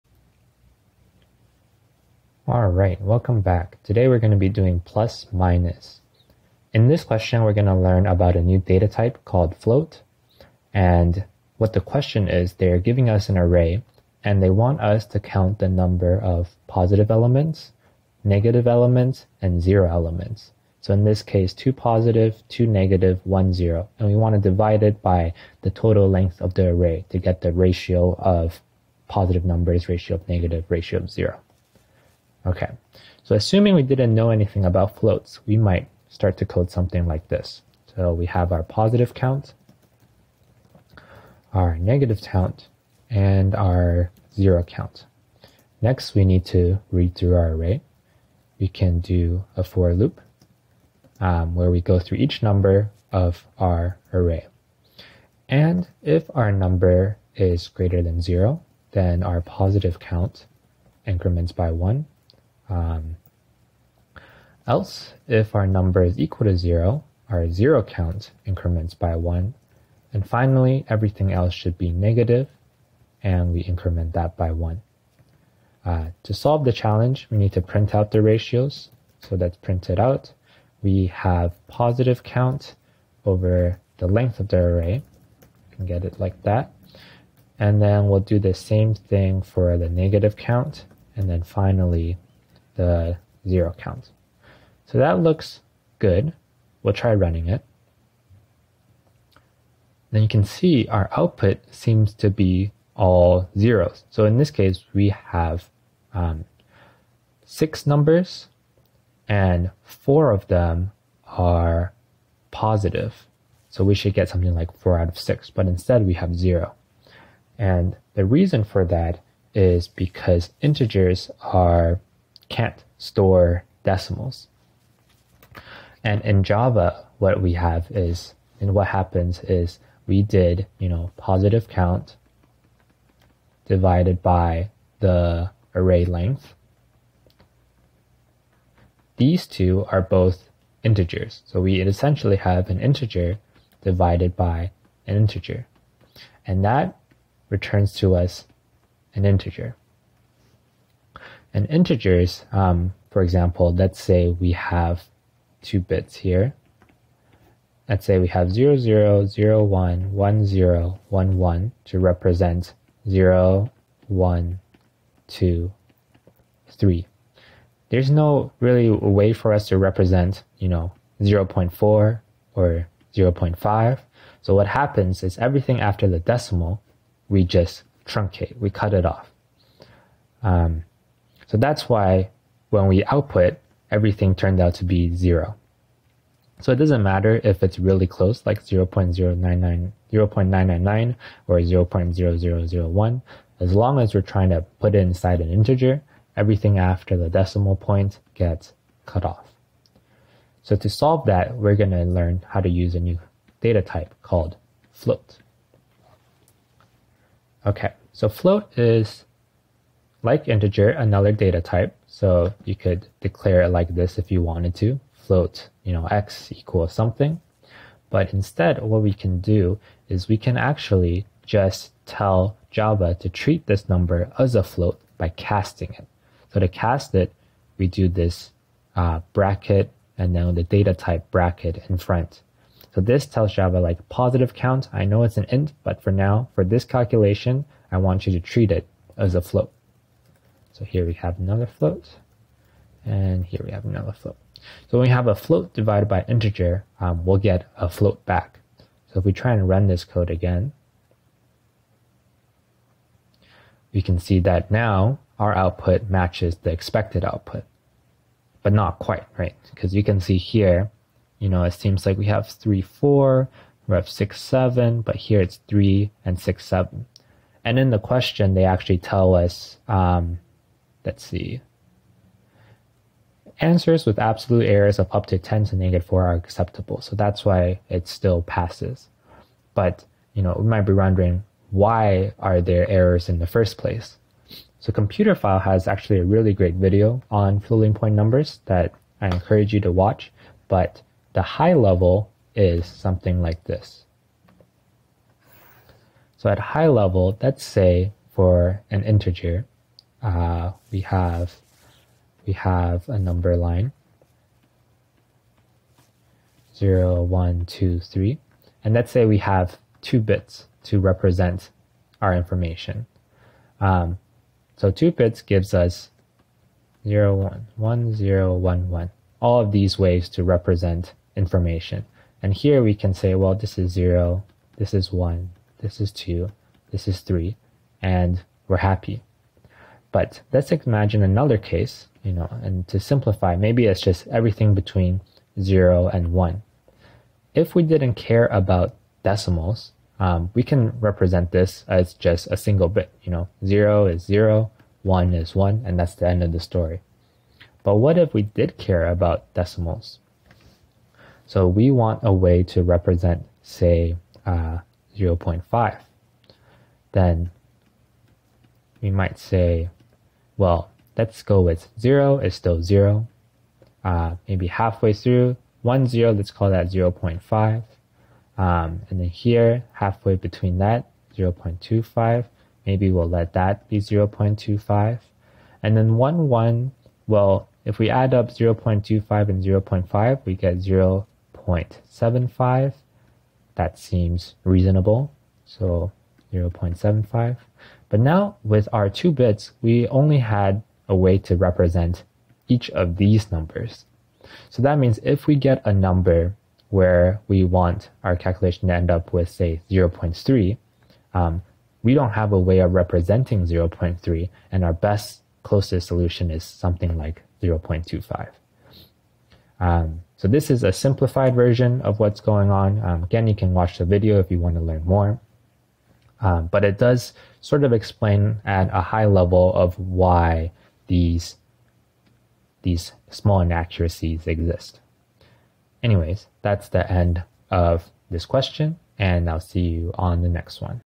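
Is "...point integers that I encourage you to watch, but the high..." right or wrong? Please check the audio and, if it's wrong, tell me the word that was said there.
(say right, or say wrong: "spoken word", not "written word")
wrong: "numbers", not "integers".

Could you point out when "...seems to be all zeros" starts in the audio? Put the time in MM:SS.
01:41.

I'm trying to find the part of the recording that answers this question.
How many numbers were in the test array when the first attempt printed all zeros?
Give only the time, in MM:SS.
01:47.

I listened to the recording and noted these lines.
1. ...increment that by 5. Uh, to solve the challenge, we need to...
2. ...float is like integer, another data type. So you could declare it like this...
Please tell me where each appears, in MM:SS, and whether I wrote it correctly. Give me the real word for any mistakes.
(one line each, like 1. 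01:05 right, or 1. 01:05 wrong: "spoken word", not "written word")
1. 01:13 wrong: "1", not "5"
2. 03:28 right.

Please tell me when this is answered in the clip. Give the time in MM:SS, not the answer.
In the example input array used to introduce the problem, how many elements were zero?
00:23.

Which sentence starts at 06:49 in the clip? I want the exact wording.
Um, so this is a simplified version of what's going on.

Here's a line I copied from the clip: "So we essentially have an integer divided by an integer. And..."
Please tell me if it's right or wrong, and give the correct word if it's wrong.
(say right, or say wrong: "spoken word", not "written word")
right.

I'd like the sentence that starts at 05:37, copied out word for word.
If we didn't care about decimals, um, we can represent this as just a single bit.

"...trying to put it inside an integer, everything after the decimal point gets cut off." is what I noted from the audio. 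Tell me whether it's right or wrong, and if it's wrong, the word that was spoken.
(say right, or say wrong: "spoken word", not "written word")
right.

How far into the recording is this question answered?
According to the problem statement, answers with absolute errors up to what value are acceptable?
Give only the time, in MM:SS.
04:35.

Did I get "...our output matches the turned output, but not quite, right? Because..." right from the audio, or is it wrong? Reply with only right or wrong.
wrong.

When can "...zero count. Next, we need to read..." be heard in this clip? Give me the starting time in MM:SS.
00:44.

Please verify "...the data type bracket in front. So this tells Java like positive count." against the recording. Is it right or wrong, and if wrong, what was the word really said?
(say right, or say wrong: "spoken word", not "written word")
right.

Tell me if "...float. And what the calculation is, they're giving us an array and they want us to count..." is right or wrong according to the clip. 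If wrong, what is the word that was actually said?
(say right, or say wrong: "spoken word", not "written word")
wrong: "question", not "calculation".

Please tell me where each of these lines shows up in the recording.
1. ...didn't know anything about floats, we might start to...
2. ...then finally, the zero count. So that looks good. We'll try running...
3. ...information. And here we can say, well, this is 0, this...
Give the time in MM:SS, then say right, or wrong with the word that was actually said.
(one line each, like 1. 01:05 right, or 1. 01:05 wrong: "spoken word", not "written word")
1. 00:33 right
2. 01:31 right
3. 05:21 right.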